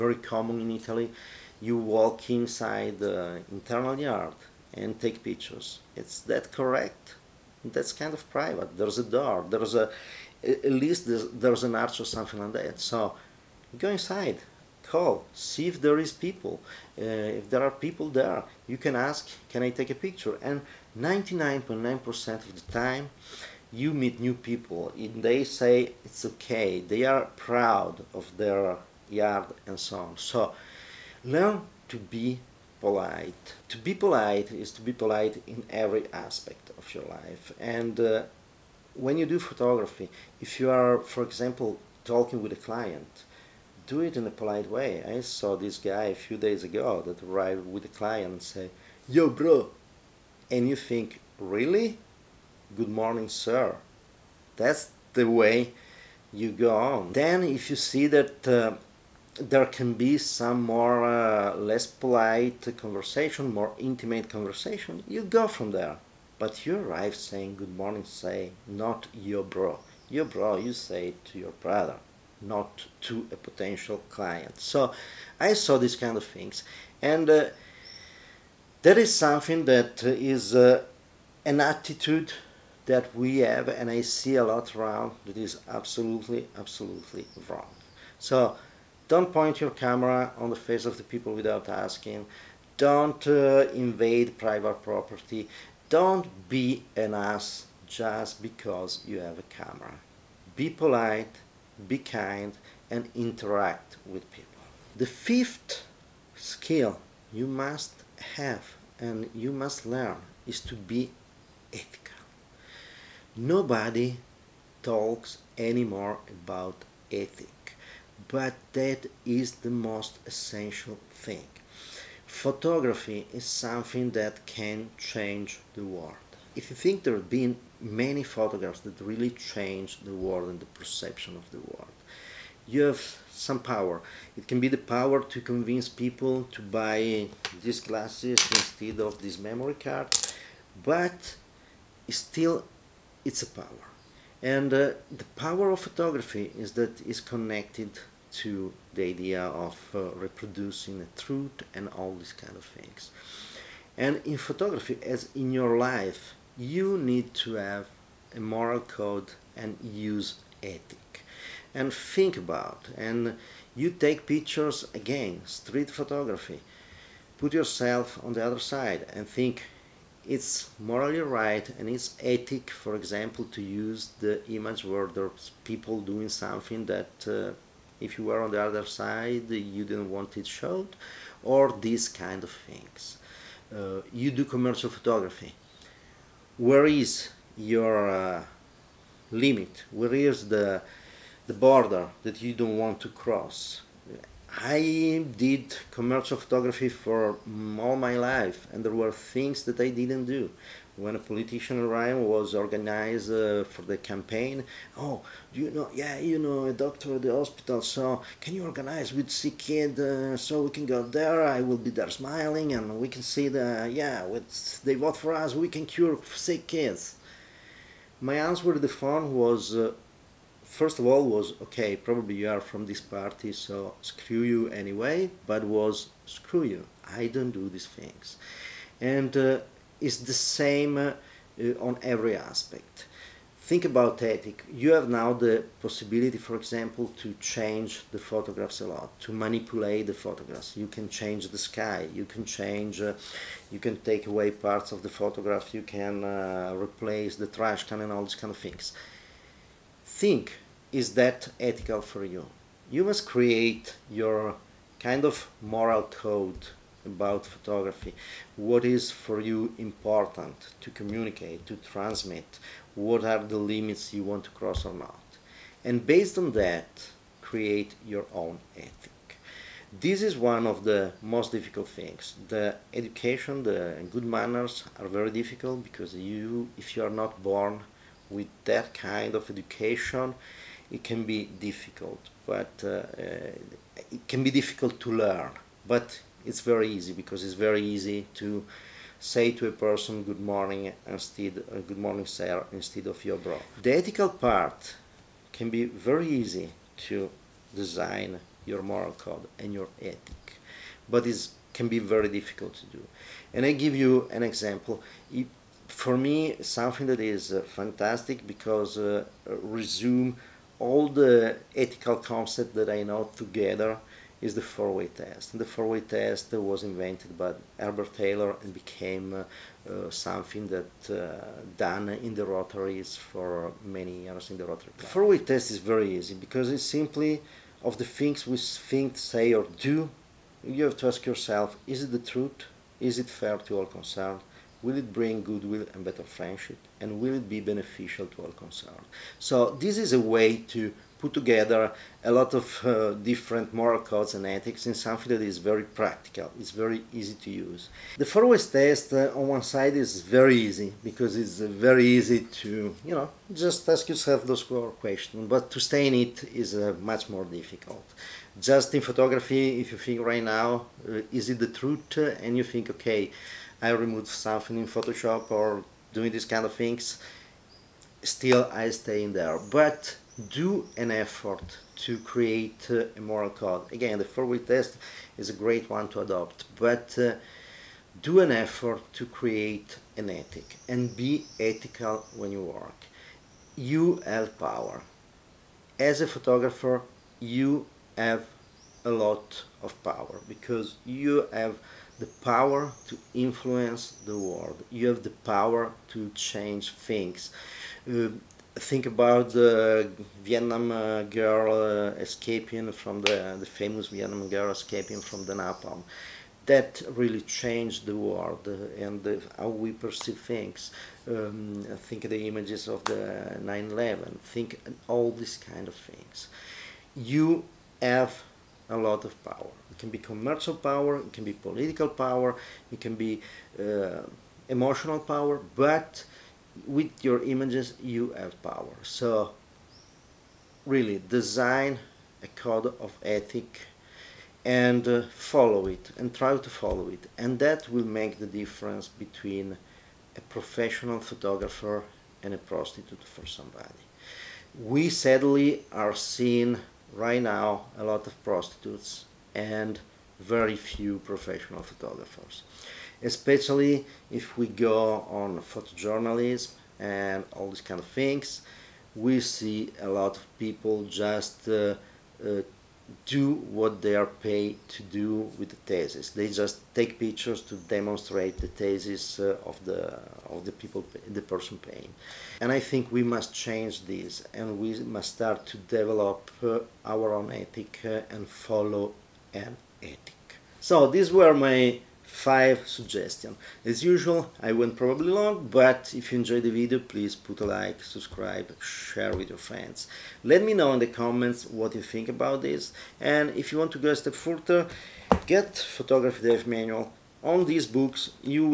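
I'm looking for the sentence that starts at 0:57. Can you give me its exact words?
Then, if you see that uh, there can be some more uh, less polite conversation, more intimate conversation, you go from there.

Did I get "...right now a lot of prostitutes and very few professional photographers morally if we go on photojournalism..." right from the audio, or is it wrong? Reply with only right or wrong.
wrong.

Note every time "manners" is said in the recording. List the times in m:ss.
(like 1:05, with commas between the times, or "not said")
4:34.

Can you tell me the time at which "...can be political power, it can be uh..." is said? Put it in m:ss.
7:01.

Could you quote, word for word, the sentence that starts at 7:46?
They just take pictures to demonstrate the thesis uh, of the of the people, the person paying.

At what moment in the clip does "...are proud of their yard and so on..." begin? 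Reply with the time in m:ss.
0:27.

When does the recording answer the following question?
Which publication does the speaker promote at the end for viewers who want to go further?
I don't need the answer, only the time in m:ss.
8:15.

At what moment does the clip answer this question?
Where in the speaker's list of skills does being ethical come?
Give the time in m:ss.
1:45.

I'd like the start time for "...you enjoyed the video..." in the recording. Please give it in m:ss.
8:06.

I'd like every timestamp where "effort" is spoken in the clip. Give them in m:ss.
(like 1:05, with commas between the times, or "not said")
6:11, 6:18.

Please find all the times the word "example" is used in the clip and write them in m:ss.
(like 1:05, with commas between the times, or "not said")
0:41, 2:52, 3:56, 5:04.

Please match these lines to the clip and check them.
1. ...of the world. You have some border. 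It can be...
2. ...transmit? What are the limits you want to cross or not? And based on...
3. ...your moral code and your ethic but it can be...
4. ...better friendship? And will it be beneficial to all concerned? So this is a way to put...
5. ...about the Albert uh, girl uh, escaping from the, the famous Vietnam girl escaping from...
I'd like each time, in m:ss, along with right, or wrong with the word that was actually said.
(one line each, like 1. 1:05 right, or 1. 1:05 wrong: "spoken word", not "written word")
1. 2:11 wrong: "power", not "border"
2. 4:21 right
3. 4:58 right
4. 5:36 right
5. 6:39 wrong: "Vietnam", not "Albert".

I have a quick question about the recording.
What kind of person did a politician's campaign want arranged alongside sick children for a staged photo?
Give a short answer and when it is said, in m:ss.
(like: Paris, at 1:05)
A doctor, at 3:26.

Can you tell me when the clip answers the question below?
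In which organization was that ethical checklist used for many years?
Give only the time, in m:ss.
5:24.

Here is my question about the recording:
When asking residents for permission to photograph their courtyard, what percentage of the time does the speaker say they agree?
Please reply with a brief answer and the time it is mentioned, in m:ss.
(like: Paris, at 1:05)
99.9%, at 0:20.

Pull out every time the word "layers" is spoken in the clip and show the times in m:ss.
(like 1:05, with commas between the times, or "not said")
not said.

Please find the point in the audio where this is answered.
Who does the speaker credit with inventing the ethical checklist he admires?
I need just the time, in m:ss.
5:17.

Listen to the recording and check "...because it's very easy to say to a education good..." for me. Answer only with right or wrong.
wrong.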